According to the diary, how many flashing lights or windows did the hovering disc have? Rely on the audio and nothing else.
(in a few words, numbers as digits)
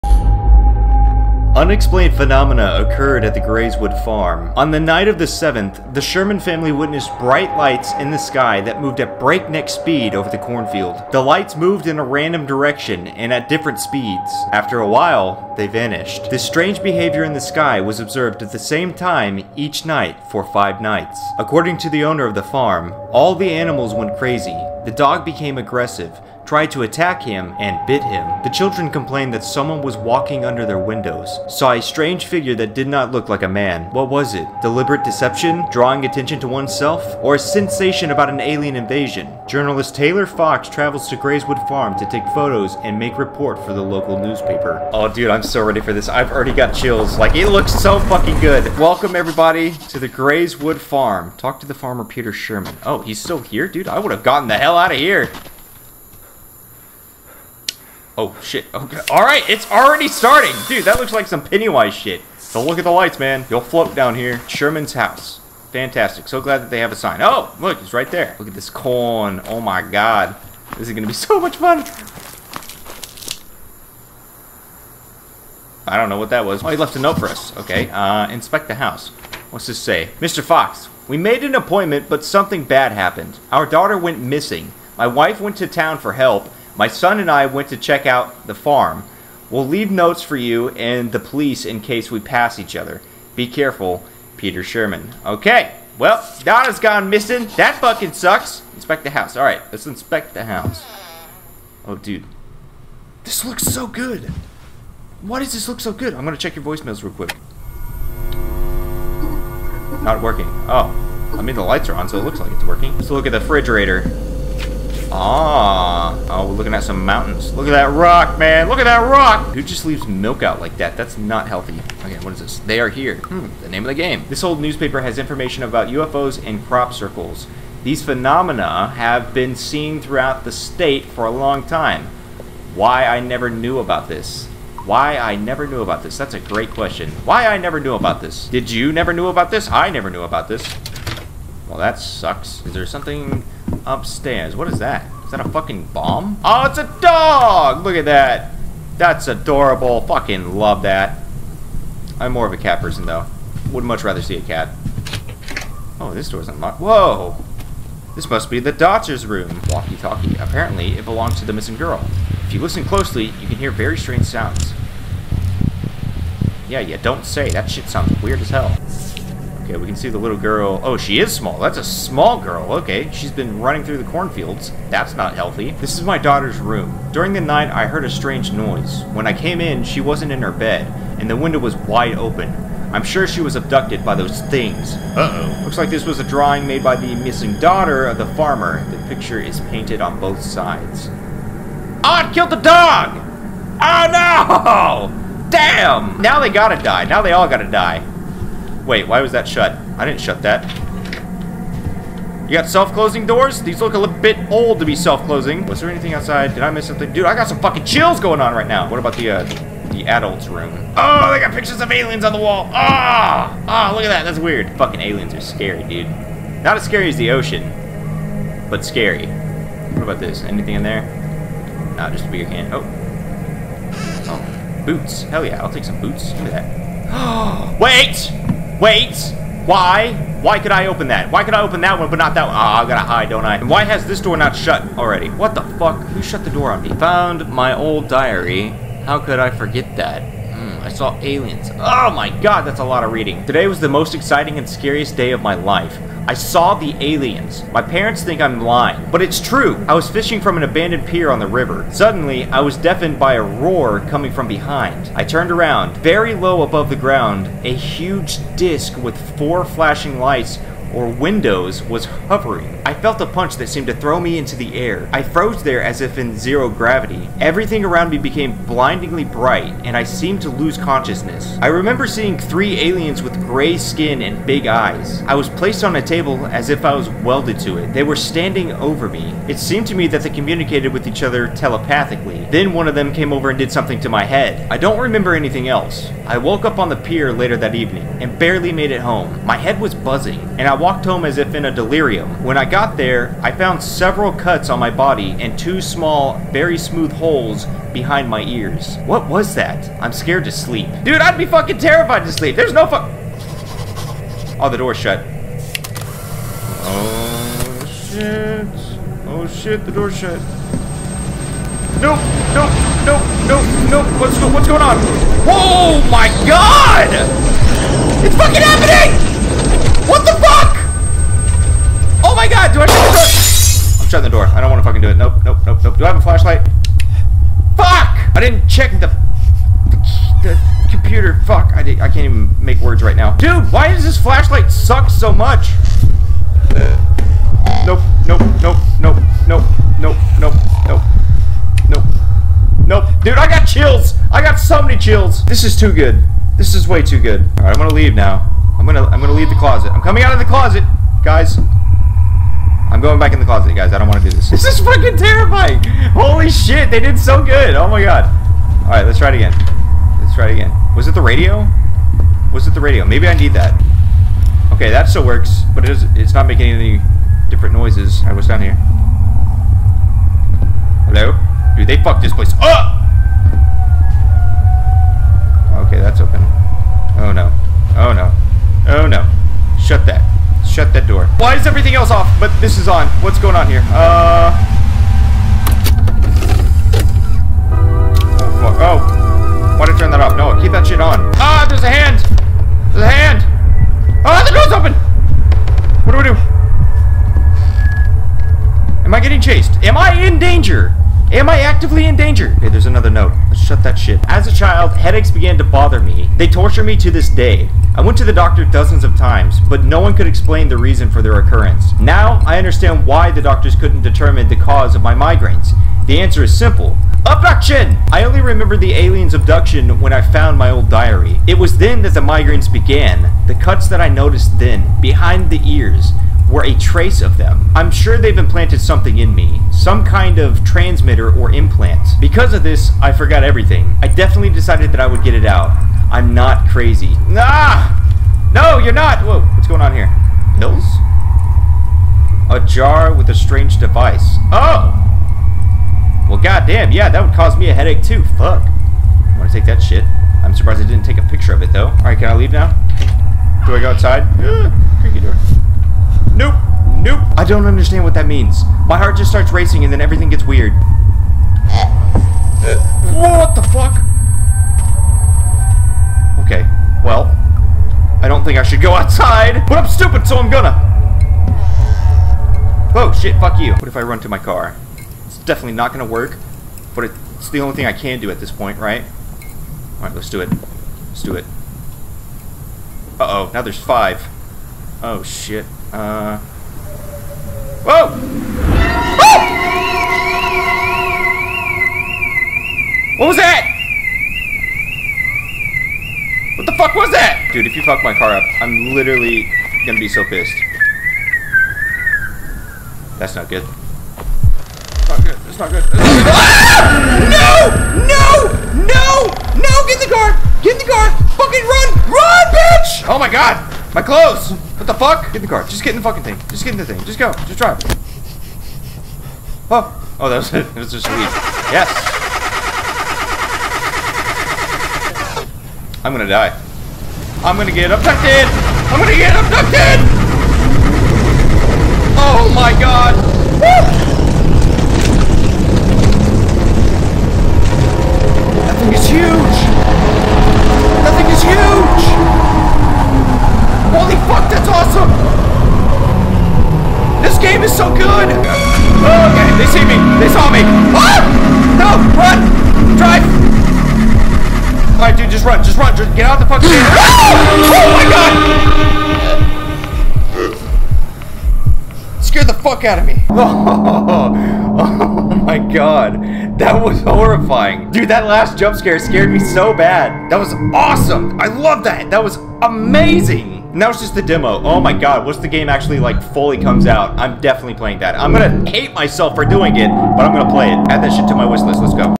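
4.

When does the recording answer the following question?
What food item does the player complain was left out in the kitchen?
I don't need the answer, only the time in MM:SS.
02:00.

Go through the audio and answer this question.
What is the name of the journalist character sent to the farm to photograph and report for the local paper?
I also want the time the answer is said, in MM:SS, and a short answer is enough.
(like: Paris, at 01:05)
Taylor Fox, at 00:39.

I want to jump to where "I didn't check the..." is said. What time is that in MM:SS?
05:28.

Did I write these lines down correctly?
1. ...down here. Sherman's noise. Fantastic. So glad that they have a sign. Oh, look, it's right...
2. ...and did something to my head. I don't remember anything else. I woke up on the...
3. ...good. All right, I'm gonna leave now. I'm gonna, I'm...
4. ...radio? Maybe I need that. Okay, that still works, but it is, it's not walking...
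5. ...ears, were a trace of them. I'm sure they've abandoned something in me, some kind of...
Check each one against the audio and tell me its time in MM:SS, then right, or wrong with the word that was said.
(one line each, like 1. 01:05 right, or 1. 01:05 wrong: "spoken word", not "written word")
1. 01:03 wrong: "house", not "noise"
2. 04:43 right
3. 05:47 right
4. 06:02 wrong: "making", not "walking"
5. 07:05 wrong: "implanted", not "abandoned".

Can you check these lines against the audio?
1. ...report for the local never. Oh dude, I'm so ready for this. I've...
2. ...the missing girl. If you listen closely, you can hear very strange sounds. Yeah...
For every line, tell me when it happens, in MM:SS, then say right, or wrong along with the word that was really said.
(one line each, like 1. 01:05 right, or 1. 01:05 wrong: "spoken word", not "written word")
1. 00:43 wrong: "newspaper", not "never"
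2. 02:41 right.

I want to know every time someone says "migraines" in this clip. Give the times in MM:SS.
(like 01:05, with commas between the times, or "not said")
06:55, 07:02.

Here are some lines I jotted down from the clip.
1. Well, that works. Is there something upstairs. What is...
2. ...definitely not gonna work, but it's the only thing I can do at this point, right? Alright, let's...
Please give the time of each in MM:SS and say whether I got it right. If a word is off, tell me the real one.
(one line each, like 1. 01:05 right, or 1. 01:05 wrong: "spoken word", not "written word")
1. 02:21 wrong: "sucks", not "works"
2. 07:55 right.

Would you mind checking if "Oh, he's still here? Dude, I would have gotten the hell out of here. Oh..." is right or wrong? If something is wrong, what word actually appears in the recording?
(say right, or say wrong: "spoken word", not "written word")
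right.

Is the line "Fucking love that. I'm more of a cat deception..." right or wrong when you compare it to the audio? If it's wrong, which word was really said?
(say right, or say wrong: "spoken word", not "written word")
wrong: "person", not "deception".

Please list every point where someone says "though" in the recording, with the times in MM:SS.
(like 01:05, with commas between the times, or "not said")
02:33, 07:31.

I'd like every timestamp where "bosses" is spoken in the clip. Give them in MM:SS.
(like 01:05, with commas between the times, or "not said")
not said.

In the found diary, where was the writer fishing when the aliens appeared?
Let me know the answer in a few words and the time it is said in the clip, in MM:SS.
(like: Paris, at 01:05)
An abandoned pier, at 04:10.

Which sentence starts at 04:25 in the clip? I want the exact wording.
I froze there as if in zero gravity.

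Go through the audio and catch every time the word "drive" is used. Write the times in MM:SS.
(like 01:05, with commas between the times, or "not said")
08:37, 09:12.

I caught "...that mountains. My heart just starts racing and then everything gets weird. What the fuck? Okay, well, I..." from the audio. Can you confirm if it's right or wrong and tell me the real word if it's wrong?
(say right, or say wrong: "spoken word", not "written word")
wrong: "means", not "mountains".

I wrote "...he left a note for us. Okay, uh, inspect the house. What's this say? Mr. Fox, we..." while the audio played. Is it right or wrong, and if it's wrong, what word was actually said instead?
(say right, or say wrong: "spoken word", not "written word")
right.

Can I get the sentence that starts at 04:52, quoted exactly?
When I got there, I found several cuts on my body and two small, very smooth holes behind my ears.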